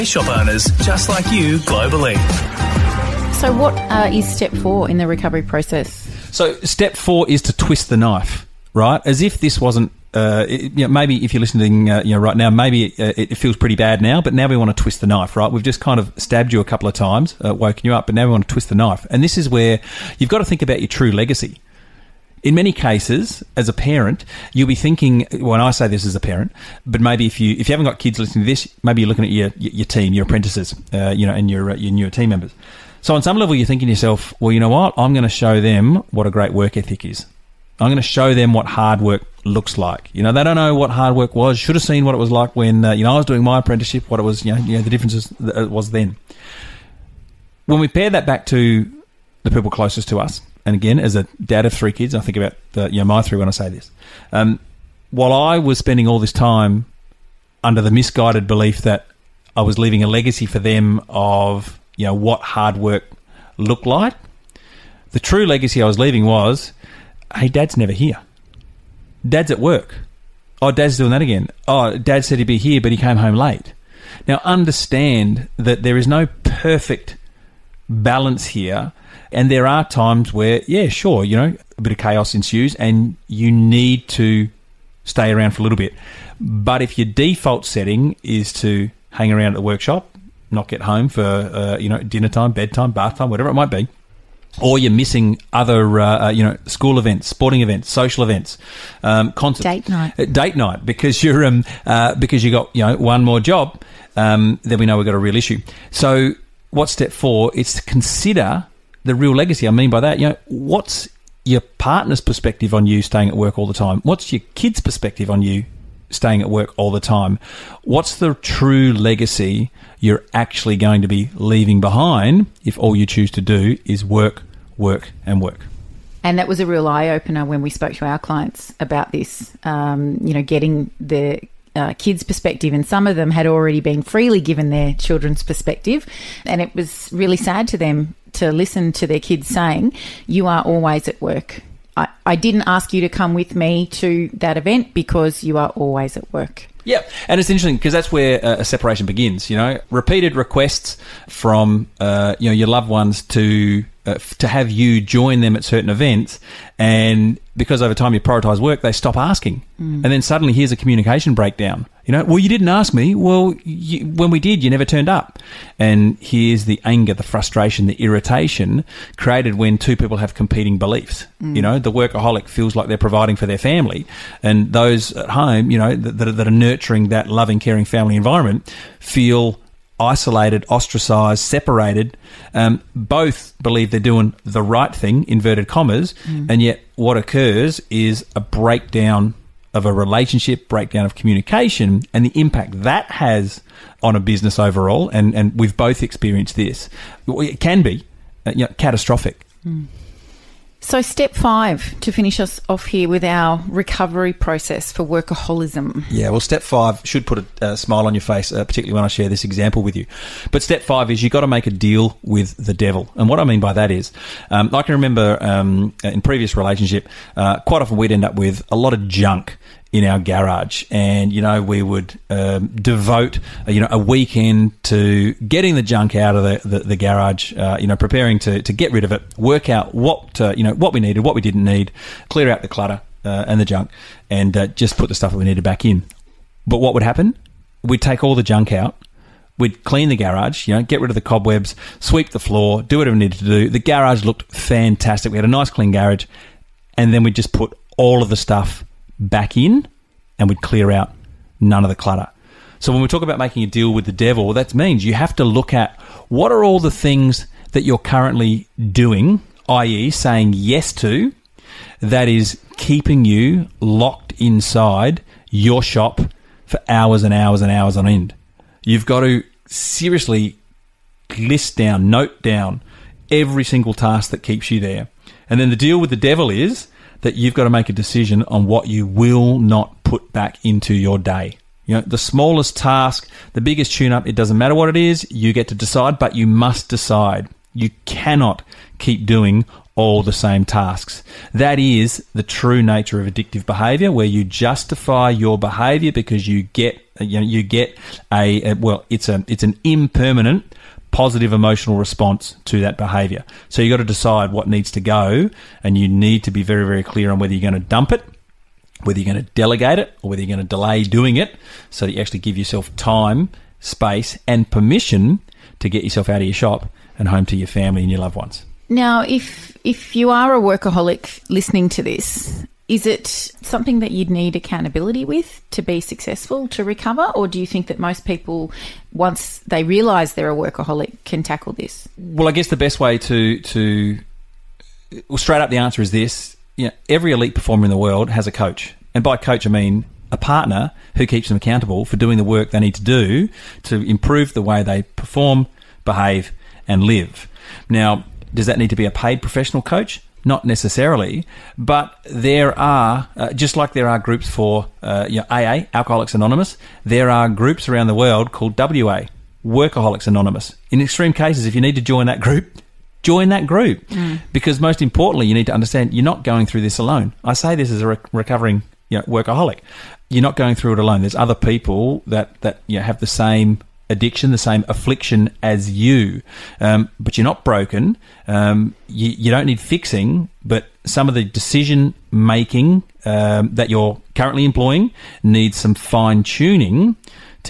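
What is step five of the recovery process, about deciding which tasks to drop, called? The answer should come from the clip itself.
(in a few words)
Make a deal with the devil.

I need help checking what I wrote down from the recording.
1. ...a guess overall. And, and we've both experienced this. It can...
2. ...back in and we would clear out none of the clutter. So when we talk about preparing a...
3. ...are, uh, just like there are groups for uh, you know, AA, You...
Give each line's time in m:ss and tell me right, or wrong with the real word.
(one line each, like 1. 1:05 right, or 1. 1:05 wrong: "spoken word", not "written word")
1. 3:14 wrong: "business", not "guess"
2. 4:09 wrong: "making", not "preparing"
3. 5:52 wrong: "Alcoholics", not "You".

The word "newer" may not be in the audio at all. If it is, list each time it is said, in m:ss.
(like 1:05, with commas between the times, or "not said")
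0:31.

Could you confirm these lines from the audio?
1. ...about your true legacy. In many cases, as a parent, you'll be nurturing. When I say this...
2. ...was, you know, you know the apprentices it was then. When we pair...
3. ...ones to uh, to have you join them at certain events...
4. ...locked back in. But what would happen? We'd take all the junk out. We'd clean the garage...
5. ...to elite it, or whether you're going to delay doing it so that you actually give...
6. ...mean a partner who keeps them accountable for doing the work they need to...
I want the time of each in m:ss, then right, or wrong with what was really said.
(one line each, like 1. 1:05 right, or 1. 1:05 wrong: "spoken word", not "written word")
1. 0:20 wrong: "thinking", not "nurturing"
2. 0:44 wrong: "differences", not "apprentices"
3. 2:32 right
4. 3:55 wrong: "needed", not "locked"
5. 5:09 wrong: "delegate", not "elite"
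6. 5:39 right.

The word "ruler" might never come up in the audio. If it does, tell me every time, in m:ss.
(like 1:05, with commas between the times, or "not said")
not said.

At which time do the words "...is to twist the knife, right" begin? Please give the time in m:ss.
0:07.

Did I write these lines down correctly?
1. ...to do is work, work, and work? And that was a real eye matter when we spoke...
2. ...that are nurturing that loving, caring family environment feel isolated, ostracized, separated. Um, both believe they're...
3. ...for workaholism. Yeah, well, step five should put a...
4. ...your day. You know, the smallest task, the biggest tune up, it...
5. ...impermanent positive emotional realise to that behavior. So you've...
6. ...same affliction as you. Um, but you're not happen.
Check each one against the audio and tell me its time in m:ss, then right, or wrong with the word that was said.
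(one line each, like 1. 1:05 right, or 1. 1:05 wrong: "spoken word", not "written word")
1. 2:03 wrong: "opener", not "matter"
2. 2:56 right
3. 3:24 right
4. 4:40 right
5. 4:59 wrong: "response", not "realise"
6. 6:14 wrong: "broken", not "happen".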